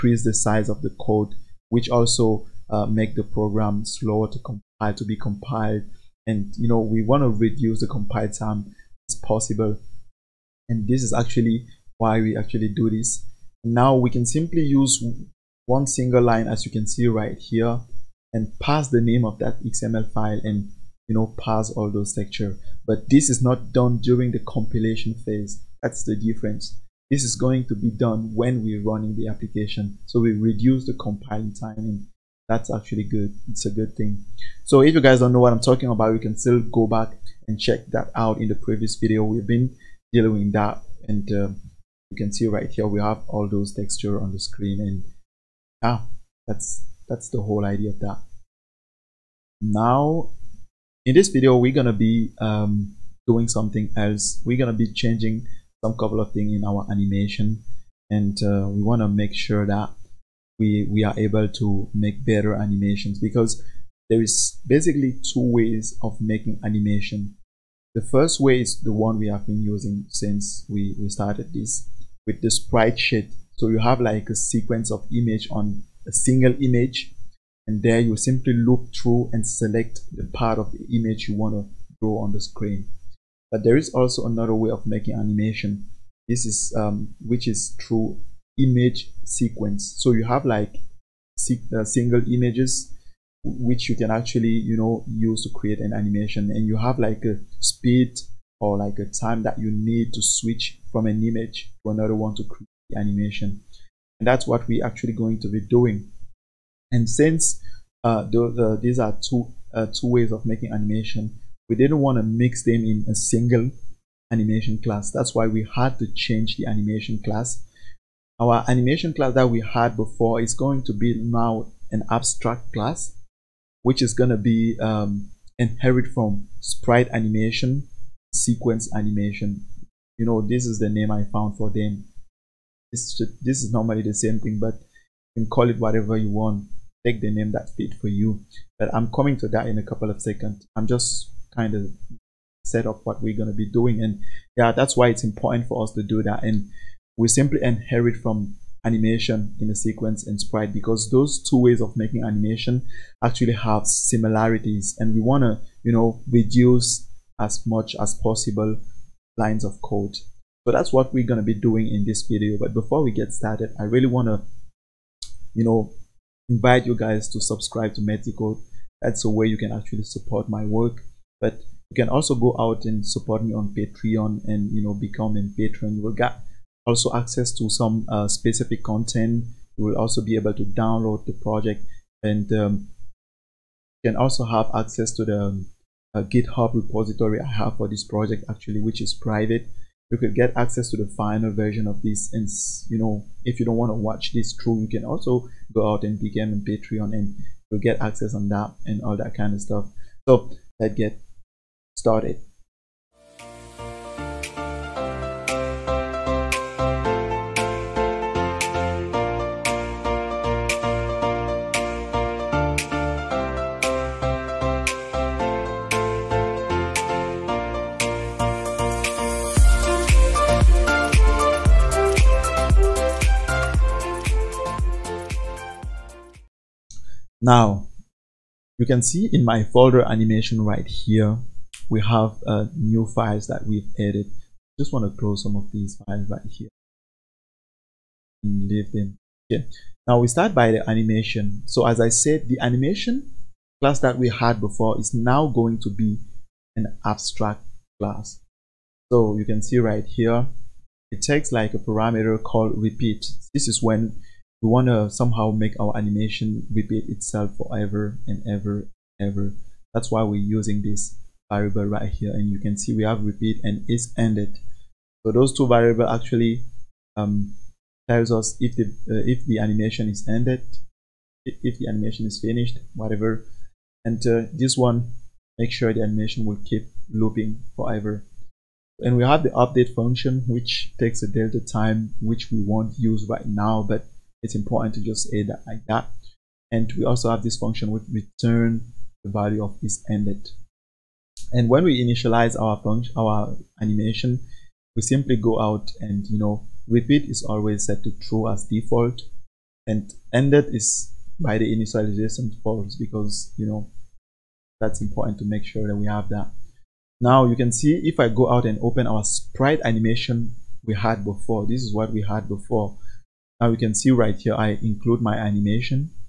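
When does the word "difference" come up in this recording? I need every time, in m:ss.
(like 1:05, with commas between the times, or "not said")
0:26.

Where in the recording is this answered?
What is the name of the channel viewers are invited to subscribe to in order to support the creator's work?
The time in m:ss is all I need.
2:48.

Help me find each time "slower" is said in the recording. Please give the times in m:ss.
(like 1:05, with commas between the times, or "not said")
0:03.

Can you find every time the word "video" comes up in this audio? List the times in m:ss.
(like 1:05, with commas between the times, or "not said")
0:38, 0:51, 2:42.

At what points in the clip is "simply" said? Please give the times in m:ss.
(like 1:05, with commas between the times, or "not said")
0:14, 1:18, 2:27, 4:55.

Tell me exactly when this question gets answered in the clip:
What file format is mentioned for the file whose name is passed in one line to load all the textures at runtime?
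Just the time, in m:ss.
0:19.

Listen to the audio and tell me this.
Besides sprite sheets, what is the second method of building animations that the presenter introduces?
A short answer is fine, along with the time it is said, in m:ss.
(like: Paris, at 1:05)
Image sequence, at 1:28.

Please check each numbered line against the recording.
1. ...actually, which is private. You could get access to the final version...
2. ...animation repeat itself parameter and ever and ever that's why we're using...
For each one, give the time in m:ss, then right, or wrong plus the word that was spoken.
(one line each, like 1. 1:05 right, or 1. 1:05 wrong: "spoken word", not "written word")
1. 3:08 right
2. 4:15 wrong: "forever", not "parameter".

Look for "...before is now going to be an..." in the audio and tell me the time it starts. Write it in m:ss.
4:04.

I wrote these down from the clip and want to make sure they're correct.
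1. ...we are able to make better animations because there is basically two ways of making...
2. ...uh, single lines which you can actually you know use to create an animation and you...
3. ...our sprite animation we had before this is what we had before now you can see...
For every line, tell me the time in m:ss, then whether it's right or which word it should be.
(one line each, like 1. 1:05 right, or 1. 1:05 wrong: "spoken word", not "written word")
1. 1:00 right
2. 1:31 wrong: "images", not "lines"
3. 5:09 right.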